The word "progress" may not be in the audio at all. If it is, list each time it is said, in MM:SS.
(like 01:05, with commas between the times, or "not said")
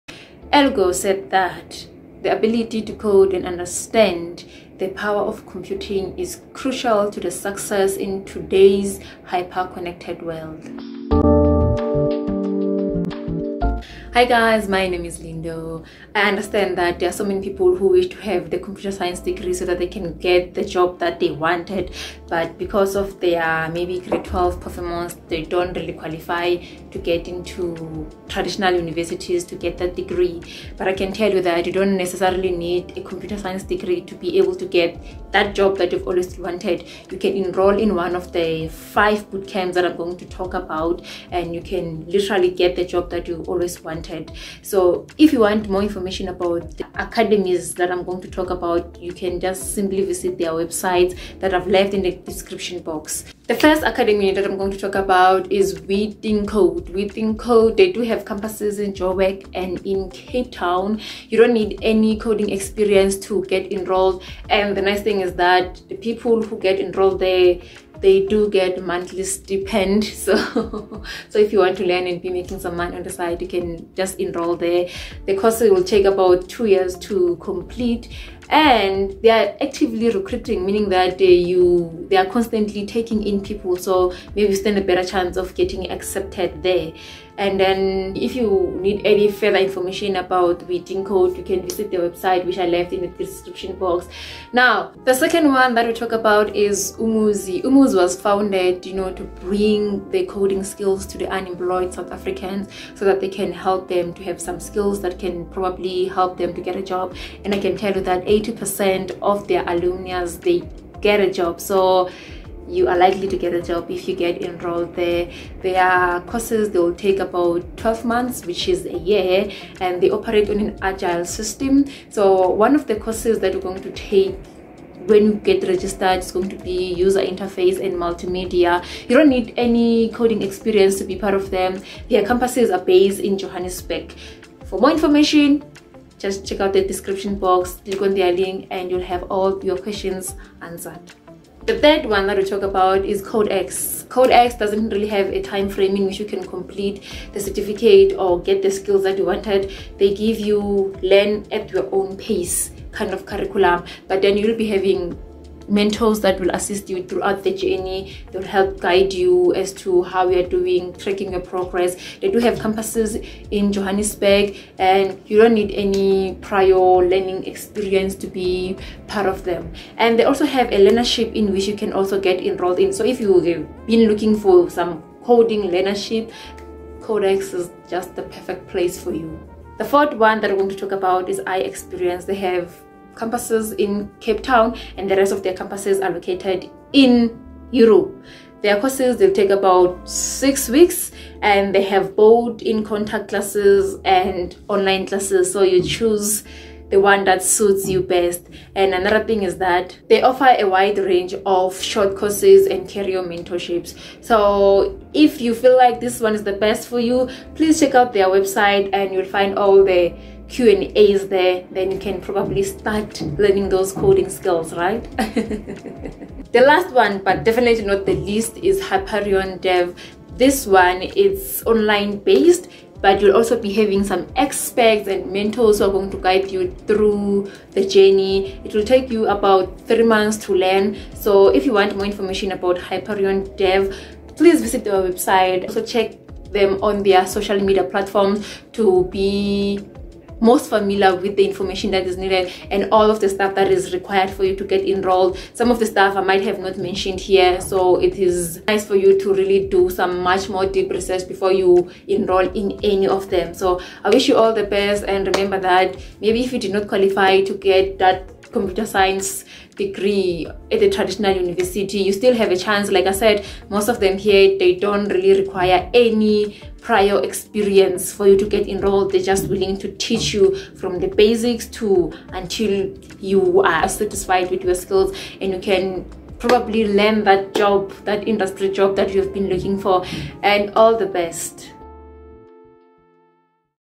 02:41.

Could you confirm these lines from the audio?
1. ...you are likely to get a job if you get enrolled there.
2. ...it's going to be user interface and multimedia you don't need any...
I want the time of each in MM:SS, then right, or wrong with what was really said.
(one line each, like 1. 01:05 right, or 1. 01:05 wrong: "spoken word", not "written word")
1. 01:52 right
2. 02:06 right.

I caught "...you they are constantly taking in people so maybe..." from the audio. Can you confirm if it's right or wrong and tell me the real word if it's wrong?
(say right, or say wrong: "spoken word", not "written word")
right.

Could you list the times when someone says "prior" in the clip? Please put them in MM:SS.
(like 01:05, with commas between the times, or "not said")
02:46, 04:26.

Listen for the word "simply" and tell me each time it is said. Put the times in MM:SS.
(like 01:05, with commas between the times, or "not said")
00:49.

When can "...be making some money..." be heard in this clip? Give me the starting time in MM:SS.
01:12.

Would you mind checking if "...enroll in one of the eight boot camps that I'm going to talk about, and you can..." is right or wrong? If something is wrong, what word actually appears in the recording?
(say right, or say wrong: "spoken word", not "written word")
wrong: "five", not "eight".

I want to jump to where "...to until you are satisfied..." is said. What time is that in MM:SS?
04:31.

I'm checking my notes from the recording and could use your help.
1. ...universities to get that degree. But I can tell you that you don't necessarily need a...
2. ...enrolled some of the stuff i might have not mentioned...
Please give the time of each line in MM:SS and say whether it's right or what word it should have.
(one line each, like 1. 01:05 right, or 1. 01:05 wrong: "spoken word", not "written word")
1. 00:28 right
2. 04:04 right.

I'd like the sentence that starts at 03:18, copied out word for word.
And another thing is that they offer a wide range of short courses and career mentorships.